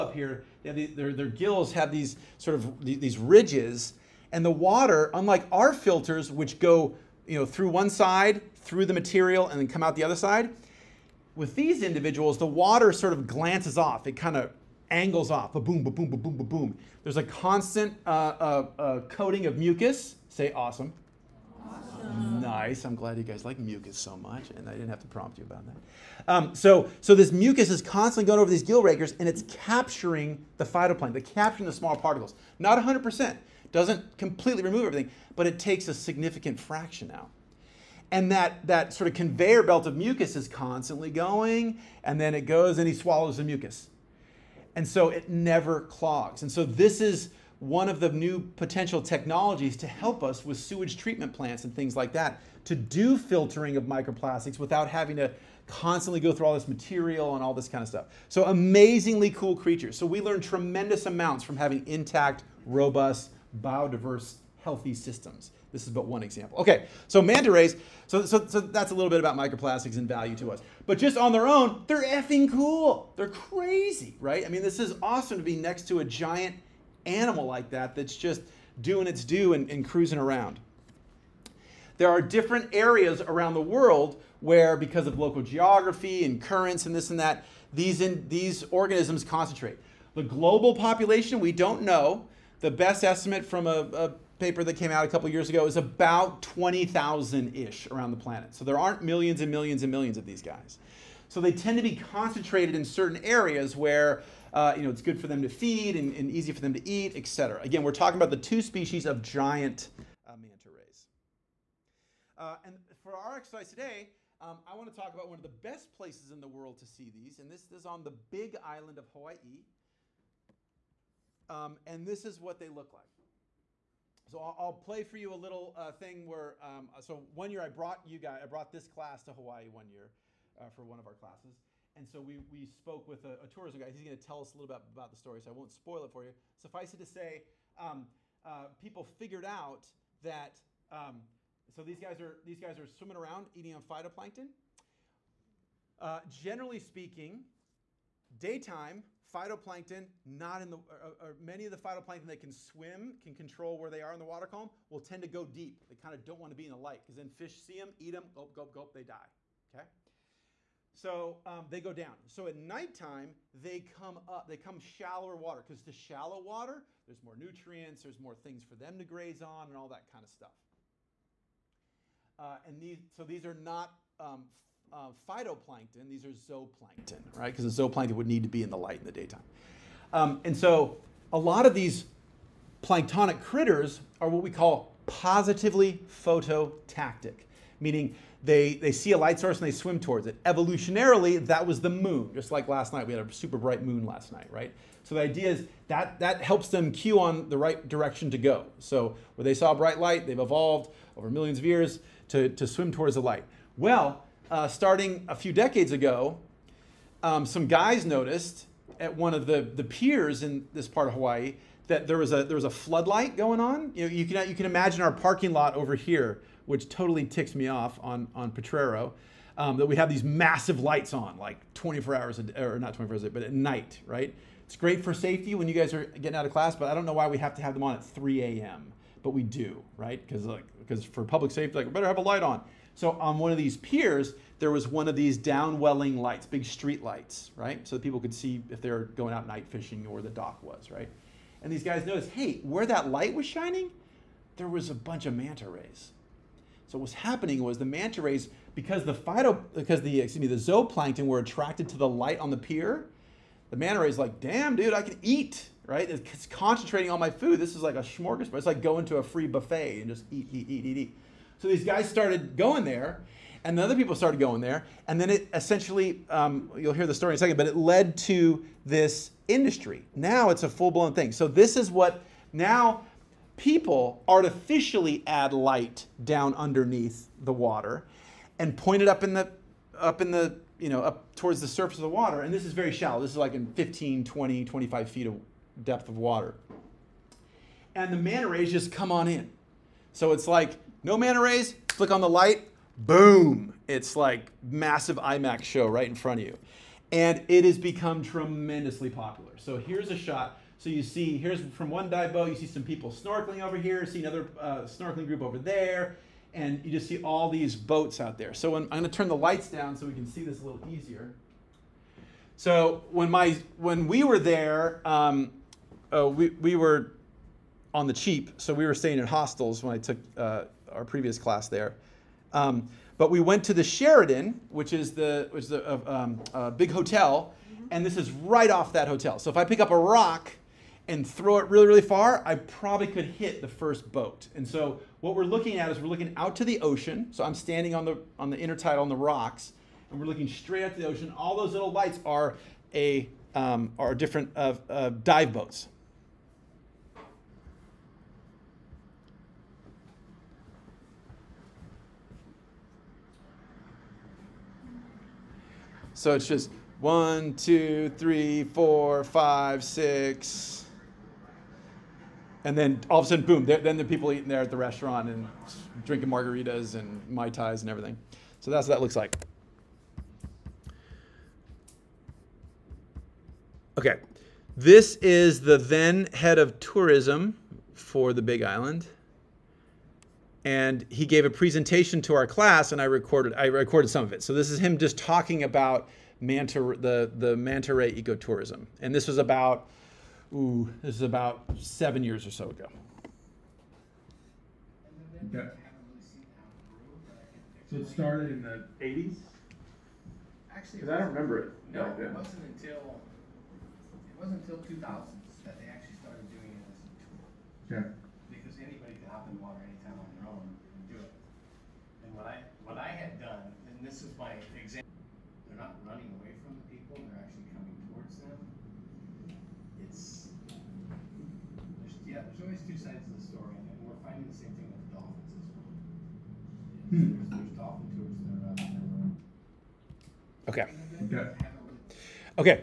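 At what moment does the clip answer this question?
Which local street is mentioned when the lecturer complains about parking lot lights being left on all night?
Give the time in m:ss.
3:38.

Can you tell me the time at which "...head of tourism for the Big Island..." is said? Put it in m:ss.
6:16.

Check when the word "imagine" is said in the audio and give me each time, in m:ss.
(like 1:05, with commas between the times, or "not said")
3:34.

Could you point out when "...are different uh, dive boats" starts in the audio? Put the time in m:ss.
5:43.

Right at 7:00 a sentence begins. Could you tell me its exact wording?
It's, there's, yeah, there's always two sides of the story, and we're finding the same thing with the dolphins as well.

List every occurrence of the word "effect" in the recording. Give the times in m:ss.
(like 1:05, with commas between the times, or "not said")
not said.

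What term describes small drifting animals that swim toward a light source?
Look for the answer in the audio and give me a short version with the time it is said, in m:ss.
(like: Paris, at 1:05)
positively phototactic, at 3:05.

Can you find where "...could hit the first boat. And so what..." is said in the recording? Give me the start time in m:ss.
5:33.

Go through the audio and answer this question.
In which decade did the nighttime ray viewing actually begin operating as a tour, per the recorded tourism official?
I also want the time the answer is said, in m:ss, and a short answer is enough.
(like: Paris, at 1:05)
2000s, at 6:44.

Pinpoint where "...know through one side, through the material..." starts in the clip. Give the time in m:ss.
0:07.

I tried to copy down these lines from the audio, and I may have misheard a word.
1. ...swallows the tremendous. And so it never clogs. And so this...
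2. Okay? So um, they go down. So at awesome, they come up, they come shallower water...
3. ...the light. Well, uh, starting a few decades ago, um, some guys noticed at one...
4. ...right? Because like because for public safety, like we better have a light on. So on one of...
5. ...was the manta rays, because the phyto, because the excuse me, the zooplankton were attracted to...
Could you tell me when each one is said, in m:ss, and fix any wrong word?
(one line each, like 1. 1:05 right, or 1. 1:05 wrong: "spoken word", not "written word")
1. 0:42 wrong: "mucus", not "tremendous"
2. 2:39 wrong: "nighttime", not "awesome"
3. 3:23 right
4. 3:49 right
5. 4:07 right.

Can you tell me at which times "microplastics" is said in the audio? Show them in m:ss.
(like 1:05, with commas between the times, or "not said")
0:53, 1:09.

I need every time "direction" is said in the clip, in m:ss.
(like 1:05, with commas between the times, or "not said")
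3:17.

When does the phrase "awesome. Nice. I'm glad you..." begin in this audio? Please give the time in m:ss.
0:21.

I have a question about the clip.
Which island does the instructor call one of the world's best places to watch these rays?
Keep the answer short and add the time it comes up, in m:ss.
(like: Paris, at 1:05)
Big Island of Hawaii, at 1:58.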